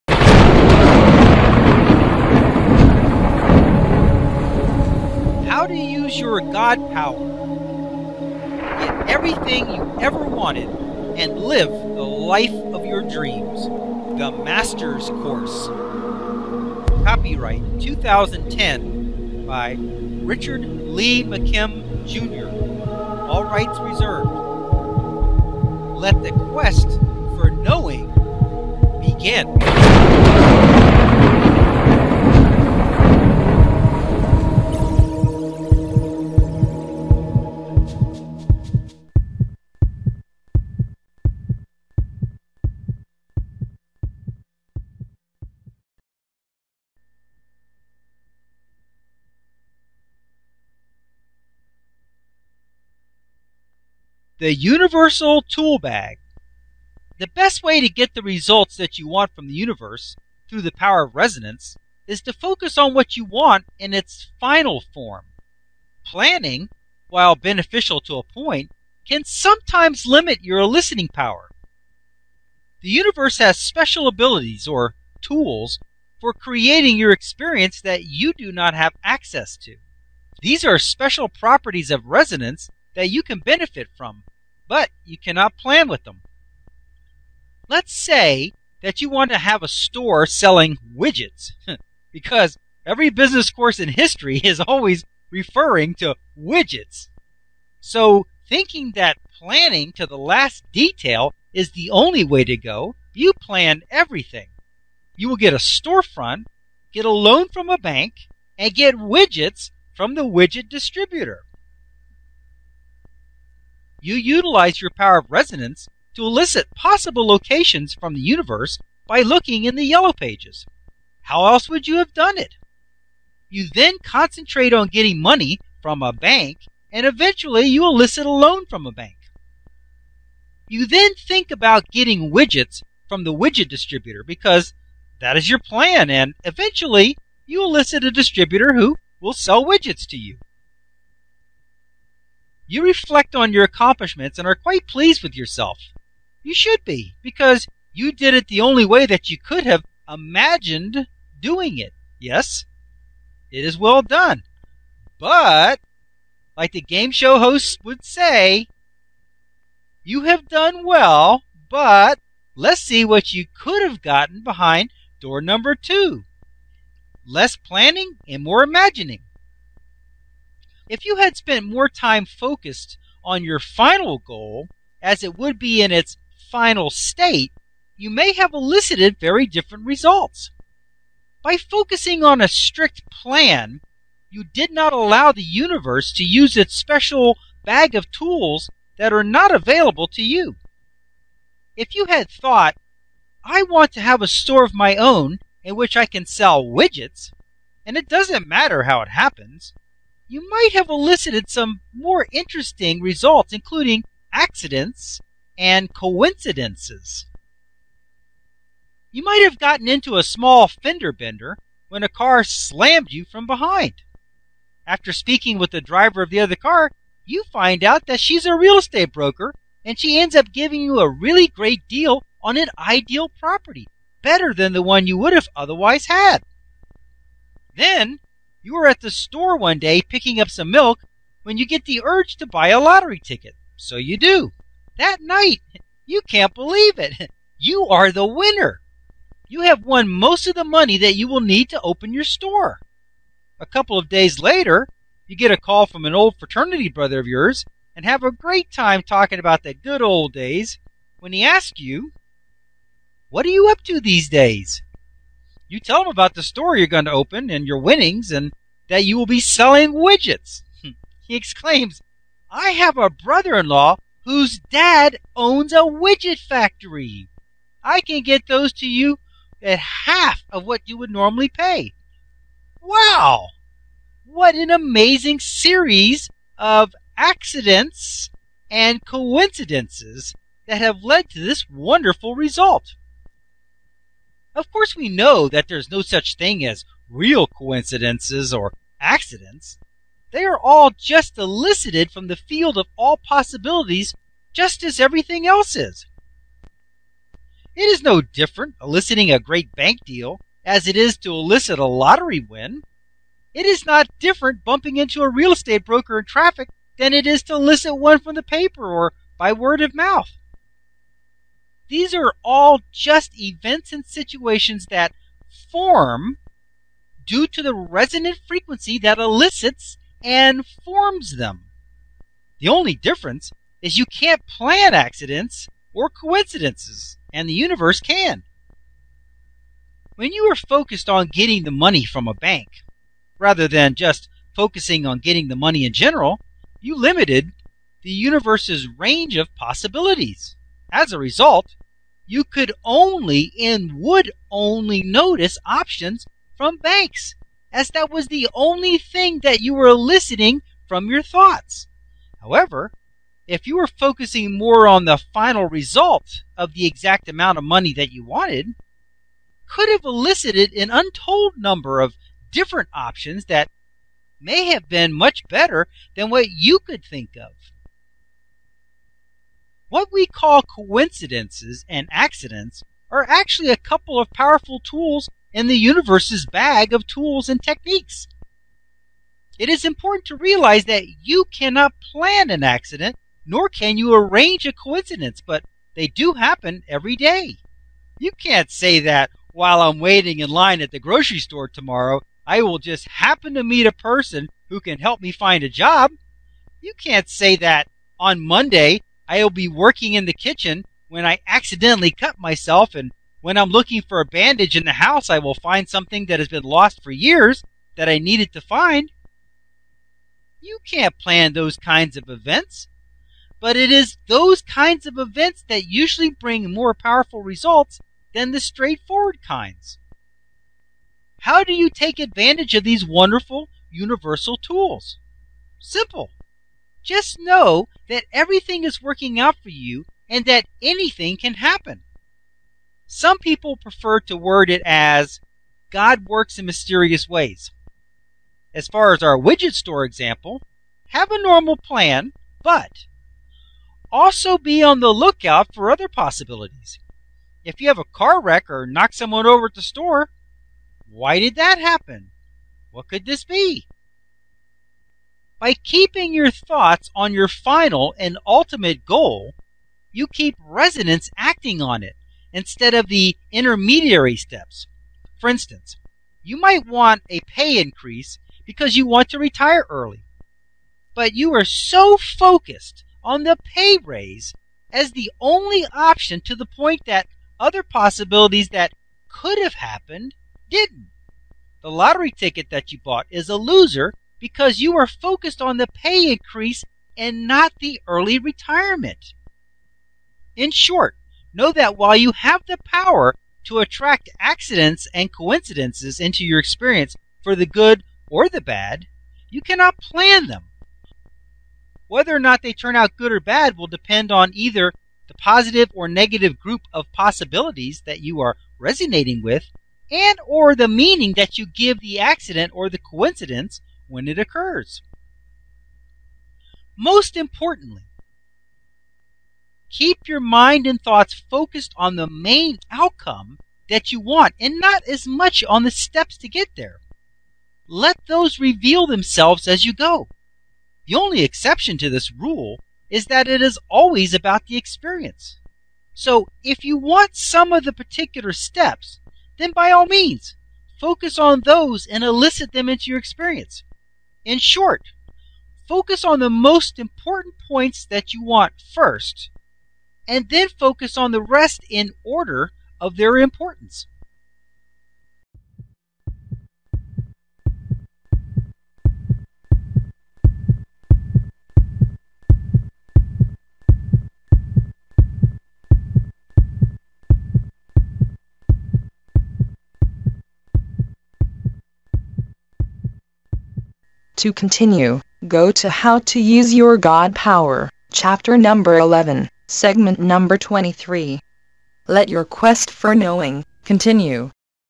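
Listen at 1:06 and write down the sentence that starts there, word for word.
Planning, while beneficial to a point, can sometimes limit your listening power.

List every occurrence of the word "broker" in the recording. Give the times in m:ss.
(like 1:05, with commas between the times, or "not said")
3:39, 5:05.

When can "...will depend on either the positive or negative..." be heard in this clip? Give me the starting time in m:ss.
8:23.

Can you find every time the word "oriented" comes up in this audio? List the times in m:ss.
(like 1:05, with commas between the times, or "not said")
not said.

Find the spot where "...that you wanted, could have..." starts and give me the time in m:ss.
5:57.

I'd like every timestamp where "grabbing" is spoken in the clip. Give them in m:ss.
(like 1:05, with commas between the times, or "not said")
not said.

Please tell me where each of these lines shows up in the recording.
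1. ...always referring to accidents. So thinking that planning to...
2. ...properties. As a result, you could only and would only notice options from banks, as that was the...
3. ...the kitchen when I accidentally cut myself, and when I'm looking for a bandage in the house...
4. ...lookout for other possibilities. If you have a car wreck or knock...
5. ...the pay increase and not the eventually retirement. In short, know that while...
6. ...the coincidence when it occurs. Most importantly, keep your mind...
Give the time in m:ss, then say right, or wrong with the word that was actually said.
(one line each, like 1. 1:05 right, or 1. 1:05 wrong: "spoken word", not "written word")
1. 1:34 wrong: "widgets", not "accidents"
2. 5:39 wrong: "possibilities", not "properties"
3. 6:40 right
4. 7:25 right
5. 8:05 wrong: "early", not "eventually"
6. 8:32 right.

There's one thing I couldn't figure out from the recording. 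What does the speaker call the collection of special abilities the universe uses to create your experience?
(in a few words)
the Universal Tool Bag.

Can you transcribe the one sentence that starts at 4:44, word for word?
Of course, we know that there's no such thing as real coincidences or accidents.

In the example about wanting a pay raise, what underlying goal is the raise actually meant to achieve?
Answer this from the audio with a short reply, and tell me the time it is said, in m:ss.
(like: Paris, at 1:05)
retire early, at 7:49.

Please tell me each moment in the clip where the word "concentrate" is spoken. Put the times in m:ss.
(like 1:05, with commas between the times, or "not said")
2:04.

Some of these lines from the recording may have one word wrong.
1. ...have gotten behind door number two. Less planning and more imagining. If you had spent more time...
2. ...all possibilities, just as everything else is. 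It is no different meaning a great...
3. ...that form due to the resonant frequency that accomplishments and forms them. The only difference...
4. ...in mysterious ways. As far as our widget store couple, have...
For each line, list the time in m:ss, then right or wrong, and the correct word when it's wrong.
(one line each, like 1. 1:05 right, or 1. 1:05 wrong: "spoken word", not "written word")
1. 2:43 right
2. 4:52 wrong: "eliciting", not "meaning"
3. 5:14 wrong: "elicits", not "accomplishments"
4. 7:16 wrong: "example", not "couple".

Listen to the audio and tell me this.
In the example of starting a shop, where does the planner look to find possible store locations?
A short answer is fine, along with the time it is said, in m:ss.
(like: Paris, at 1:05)
the yellow pages, at 1:59.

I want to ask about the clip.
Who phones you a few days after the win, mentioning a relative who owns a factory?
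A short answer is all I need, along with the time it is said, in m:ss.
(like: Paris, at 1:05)
fraternity brother, at 4:06.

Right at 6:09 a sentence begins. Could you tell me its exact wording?
What we call coincidences and accidents are actually a couple of powerful tools in the universe's bag of tools and techniques.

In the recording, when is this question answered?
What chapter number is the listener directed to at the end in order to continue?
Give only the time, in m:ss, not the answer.
9:38.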